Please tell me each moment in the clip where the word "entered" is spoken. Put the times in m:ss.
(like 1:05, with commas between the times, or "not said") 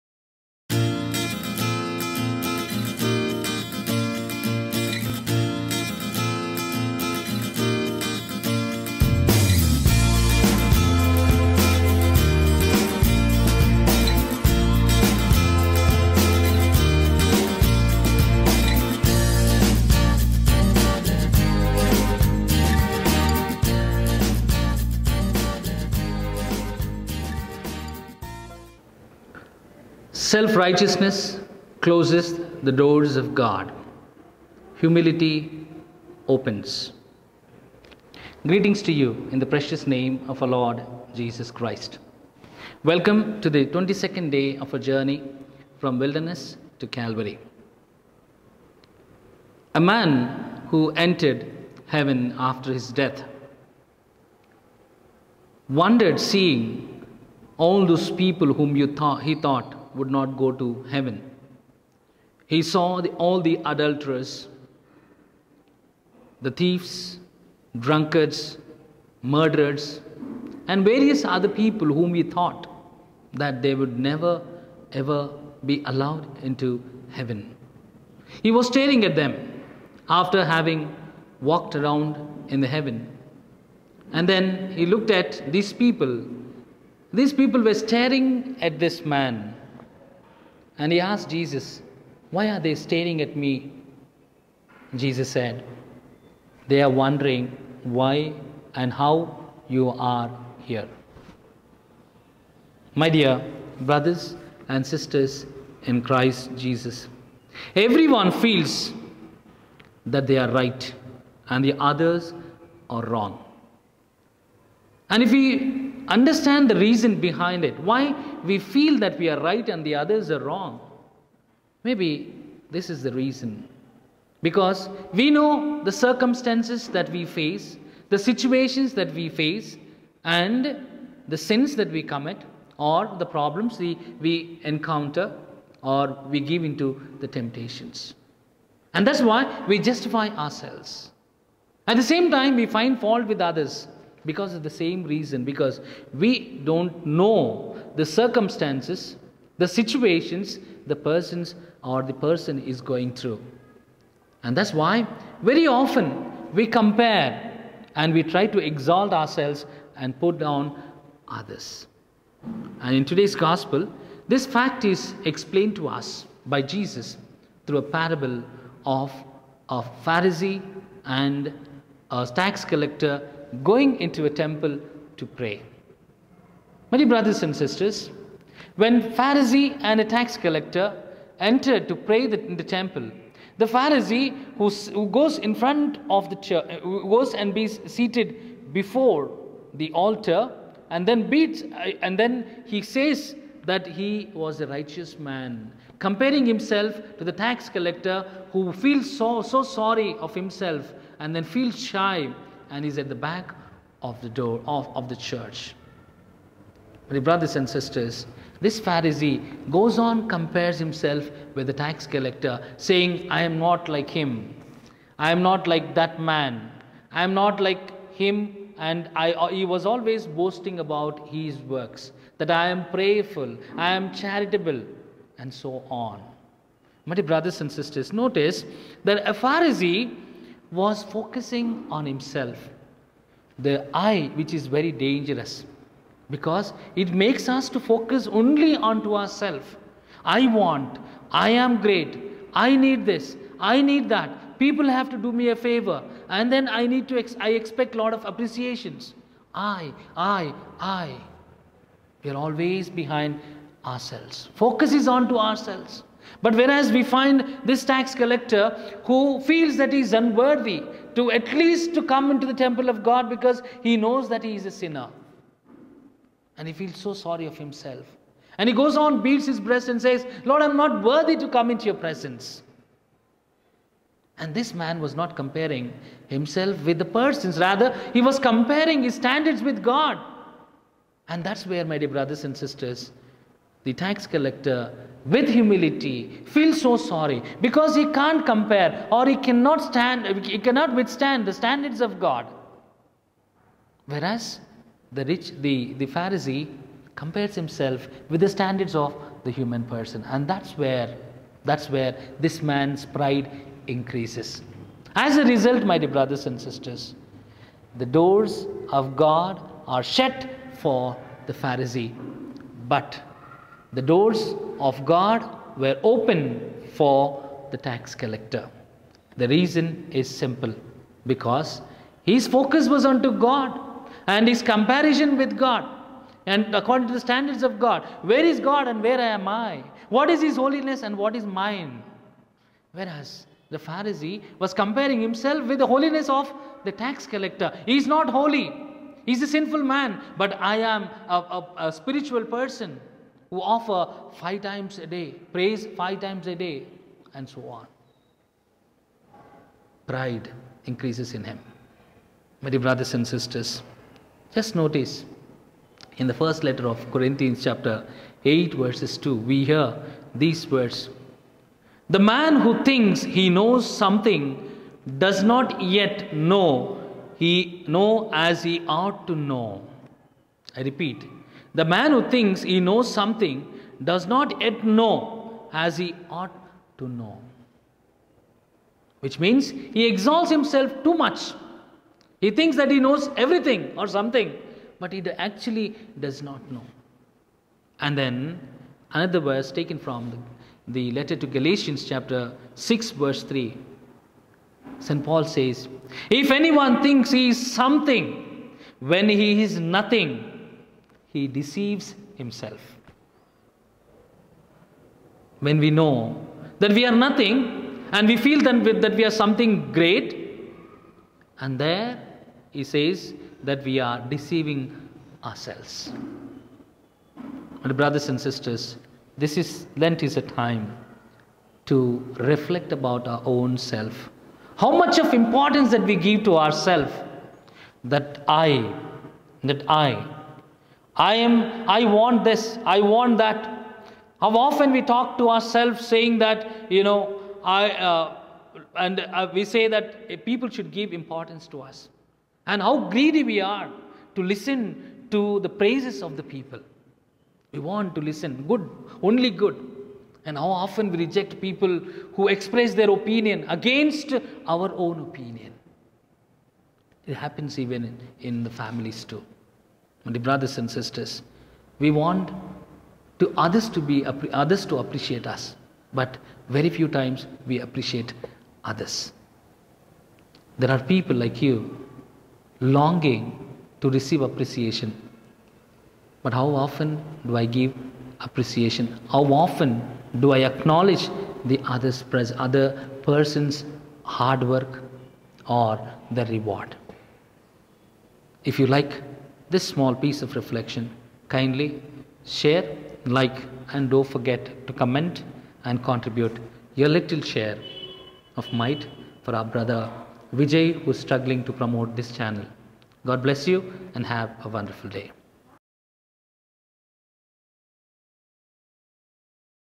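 0:50, 3:01.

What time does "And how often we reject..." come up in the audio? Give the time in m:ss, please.
7:30.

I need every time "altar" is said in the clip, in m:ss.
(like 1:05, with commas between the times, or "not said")
3:09.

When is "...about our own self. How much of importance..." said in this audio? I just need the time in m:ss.
7:02.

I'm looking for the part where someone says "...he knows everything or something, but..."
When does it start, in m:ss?
6:22.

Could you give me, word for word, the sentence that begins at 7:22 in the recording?
And how greedy we are to listen to the praises of the people.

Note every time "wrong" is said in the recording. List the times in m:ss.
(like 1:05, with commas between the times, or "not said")
1:53, 2:00.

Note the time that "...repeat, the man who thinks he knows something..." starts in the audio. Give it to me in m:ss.
6:10.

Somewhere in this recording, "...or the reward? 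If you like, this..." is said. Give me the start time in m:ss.
8:05.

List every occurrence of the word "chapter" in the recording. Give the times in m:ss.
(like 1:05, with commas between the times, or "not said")
5:57, 6:32.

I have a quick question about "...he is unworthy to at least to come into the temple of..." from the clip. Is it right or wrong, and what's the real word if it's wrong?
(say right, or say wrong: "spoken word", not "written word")
right.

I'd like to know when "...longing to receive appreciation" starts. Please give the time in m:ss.
7:52.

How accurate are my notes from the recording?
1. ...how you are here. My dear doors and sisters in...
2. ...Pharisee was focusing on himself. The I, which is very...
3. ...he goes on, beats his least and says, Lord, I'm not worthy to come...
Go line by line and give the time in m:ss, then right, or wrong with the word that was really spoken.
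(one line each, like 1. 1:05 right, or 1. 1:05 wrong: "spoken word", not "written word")
1. 1:38 wrong: "brothers", not "doors"
2. 3:49 right
3. 4:28 wrong: "breast", not "least".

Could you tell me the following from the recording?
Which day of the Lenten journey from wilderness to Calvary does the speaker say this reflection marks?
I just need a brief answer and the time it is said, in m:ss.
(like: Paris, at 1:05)
22nd, at 0:43.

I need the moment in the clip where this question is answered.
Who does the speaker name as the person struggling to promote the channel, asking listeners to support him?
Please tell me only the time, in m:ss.
8:20.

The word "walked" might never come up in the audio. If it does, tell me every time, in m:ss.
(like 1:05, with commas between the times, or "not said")
1:21.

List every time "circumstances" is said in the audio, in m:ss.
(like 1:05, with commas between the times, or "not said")
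2:05, 2:28.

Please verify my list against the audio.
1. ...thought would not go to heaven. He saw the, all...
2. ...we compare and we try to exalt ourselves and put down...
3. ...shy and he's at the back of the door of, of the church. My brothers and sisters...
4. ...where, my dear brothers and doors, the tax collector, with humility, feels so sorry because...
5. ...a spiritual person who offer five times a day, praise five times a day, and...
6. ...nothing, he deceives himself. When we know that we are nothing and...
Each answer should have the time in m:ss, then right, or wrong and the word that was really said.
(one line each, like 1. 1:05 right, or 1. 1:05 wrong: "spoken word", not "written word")
1. 0:59 right
2. 2:36 right
3. 3:21 right
4. 4:41 wrong: "sisters", not "doors"
5. 5:41 right
6. 6:39 right.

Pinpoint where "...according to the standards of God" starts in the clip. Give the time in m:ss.
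5:26.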